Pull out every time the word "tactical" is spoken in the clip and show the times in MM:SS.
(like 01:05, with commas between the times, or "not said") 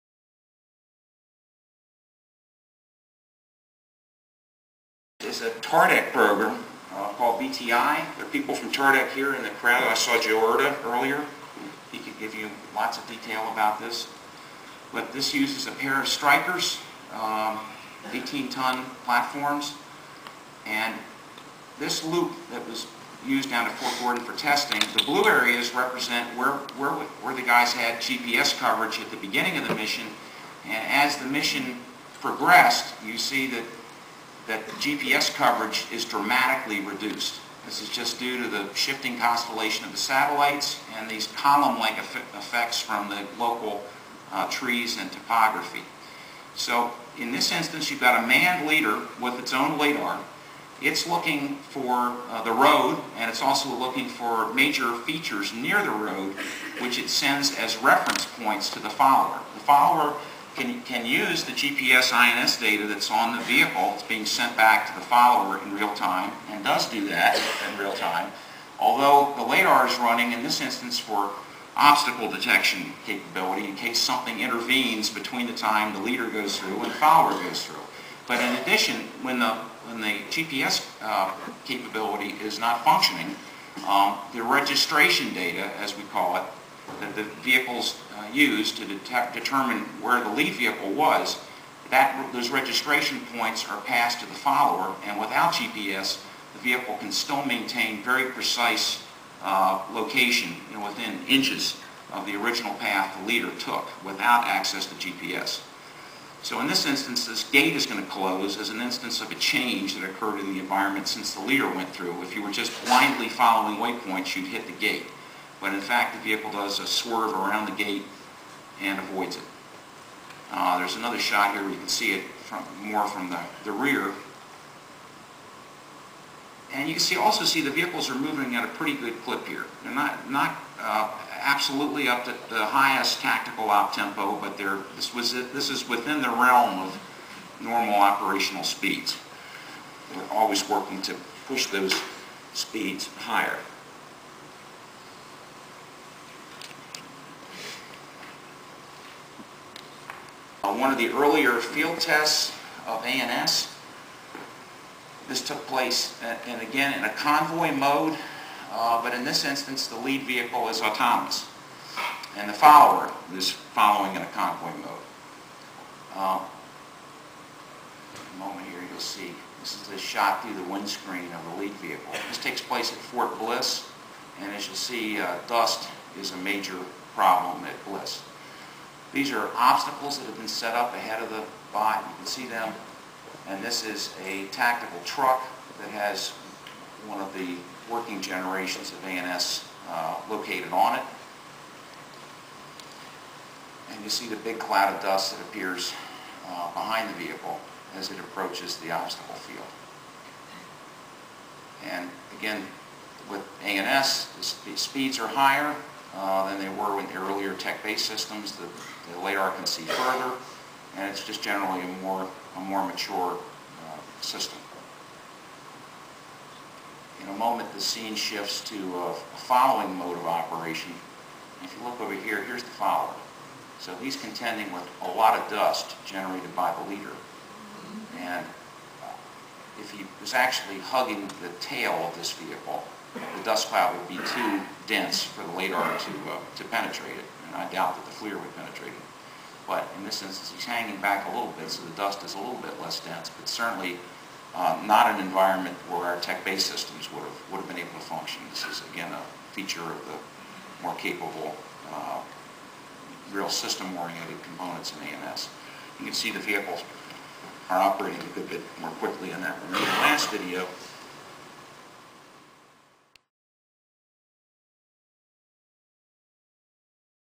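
02:13, 03:04.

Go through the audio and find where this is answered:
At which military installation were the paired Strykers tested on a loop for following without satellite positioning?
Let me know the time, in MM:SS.
00:23.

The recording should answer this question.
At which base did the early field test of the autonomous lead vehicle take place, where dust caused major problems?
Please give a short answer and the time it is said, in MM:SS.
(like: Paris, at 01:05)
Fort Bliss, at 02:52.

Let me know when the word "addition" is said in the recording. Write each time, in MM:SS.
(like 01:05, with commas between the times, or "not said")
01:18.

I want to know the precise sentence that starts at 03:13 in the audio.
And you see the big cloud of dust that appears uh, behind the vehicle as it approaches the obstacle field.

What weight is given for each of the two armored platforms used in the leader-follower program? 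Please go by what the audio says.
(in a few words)
18 tons.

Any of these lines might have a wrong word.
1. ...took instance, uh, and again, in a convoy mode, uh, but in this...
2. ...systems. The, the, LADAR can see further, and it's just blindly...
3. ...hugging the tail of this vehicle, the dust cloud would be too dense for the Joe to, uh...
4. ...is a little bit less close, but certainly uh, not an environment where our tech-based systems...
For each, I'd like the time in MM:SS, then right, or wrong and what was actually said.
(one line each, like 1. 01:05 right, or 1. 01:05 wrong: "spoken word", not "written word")
1. 02:35 wrong: "place", not "instance"
2. 03:28 wrong: "generally", not "blindly"
3. 03:50 wrong: "LADAR", not "Joe"
4. 04:02 wrong: "dense", not "close".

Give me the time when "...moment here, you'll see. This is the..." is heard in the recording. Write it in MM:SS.
02:48.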